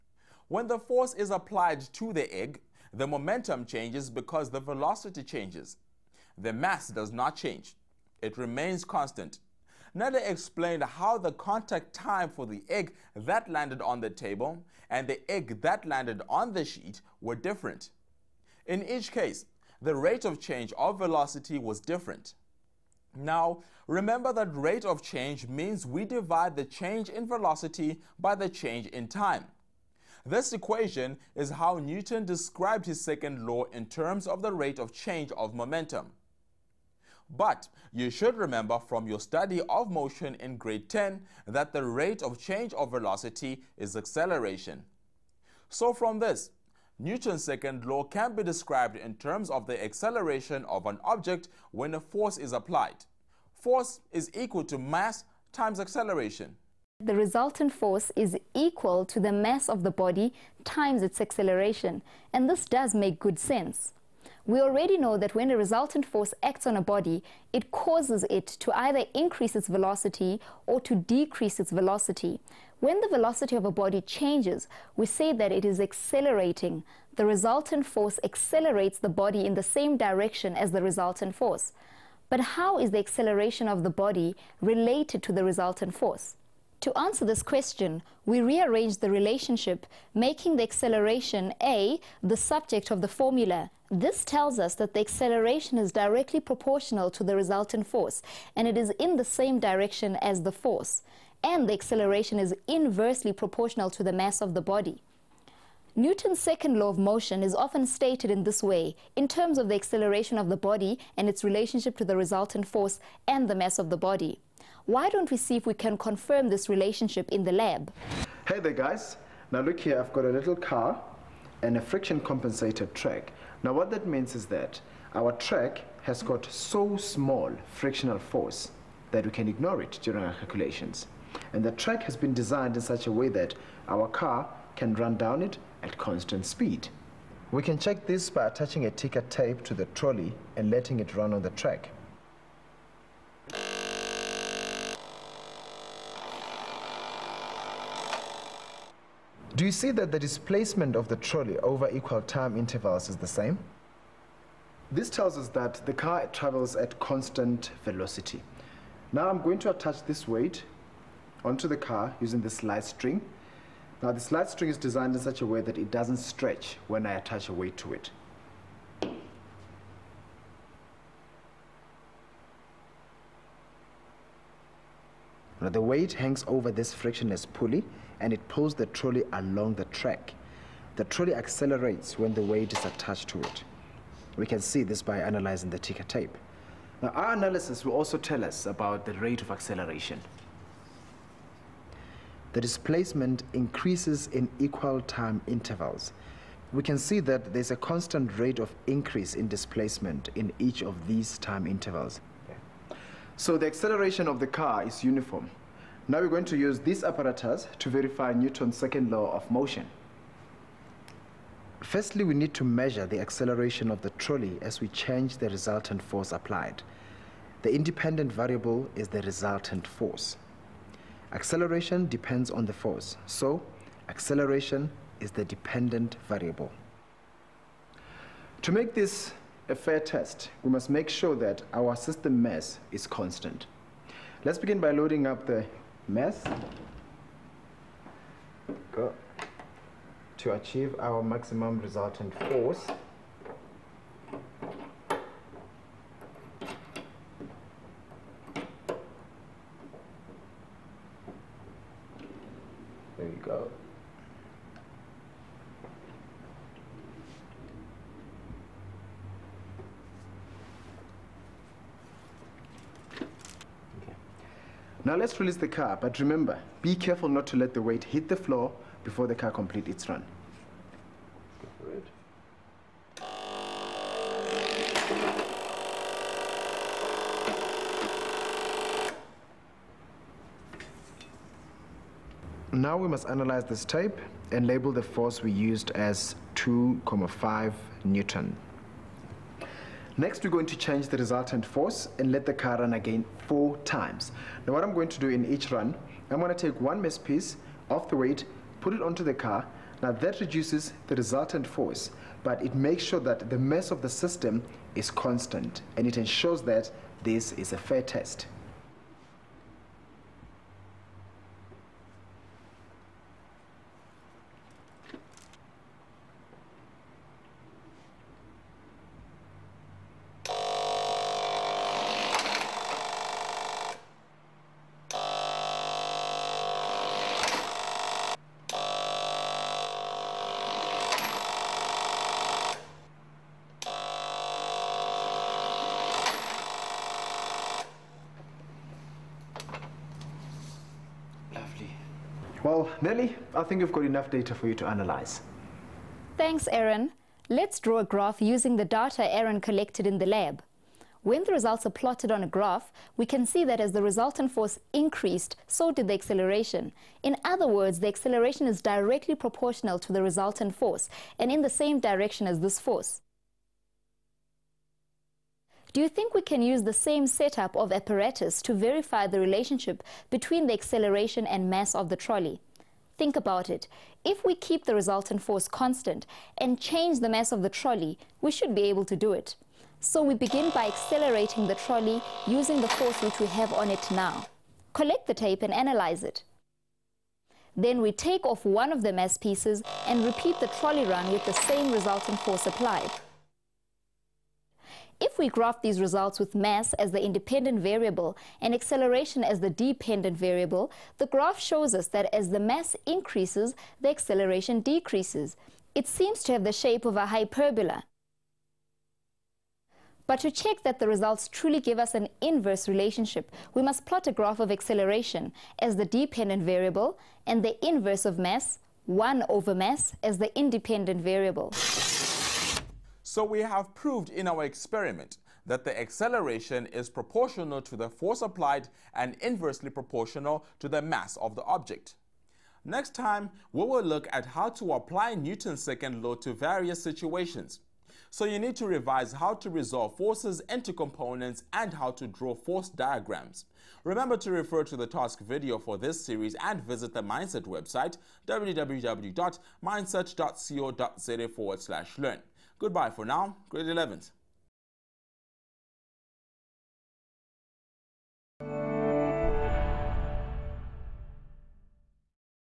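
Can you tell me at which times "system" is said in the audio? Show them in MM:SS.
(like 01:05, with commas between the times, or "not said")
03:51, 05:04.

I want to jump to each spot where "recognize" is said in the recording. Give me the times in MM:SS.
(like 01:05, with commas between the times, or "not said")
not said.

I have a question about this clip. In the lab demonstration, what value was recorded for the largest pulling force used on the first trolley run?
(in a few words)
2.5 N.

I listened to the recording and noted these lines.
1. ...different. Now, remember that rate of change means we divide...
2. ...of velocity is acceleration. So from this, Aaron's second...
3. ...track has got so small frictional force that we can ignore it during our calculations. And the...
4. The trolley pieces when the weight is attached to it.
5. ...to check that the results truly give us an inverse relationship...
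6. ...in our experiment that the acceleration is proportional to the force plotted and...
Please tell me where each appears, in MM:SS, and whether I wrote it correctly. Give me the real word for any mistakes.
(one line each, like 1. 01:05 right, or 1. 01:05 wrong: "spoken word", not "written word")
1. 00:21 right
2. 00:42 wrong: "Newton", not "Aaron"
3. 02:05 right
4. 03:00 wrong: "accelerates", not "pieces"
5. 06:50 right
6. 07:04 wrong: "applied", not "plotted".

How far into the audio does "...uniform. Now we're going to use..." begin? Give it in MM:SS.
03:25.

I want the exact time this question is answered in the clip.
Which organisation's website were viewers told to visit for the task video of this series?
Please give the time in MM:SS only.
07:27.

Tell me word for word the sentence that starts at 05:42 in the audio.
Well, Nelly, I think we've got enough data for you to analyze.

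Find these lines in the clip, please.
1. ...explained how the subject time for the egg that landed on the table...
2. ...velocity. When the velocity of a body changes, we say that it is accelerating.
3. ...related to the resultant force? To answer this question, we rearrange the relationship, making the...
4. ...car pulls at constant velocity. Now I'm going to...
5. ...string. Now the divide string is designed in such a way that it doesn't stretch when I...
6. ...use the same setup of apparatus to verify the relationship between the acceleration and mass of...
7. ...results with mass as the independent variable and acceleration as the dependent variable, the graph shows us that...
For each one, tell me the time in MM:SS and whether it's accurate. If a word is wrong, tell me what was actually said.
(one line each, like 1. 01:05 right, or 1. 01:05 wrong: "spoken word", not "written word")
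1. 00:10 wrong: "contact", not "subject"
2. 01:11 right
3. 01:24 right
4. 02:35 wrong: "travels", not "pulls"
5. 02:42 wrong: "slide", not "divide"
6. 06:06 right
7. 06:36 right.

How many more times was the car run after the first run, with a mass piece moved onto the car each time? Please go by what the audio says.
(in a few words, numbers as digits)
4.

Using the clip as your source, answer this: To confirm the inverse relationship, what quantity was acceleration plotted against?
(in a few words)
1 over mass.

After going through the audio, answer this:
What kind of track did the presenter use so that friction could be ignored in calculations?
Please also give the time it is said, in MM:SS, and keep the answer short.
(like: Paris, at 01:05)
friction compensated track, at 02:01.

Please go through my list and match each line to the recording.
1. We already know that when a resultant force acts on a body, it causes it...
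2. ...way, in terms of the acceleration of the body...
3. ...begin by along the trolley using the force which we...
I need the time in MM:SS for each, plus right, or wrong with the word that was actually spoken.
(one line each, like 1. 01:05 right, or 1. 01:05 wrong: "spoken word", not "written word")
1. 01:04 right
2. 01:48 right
3. 06:20 wrong: "accelerating", not "along".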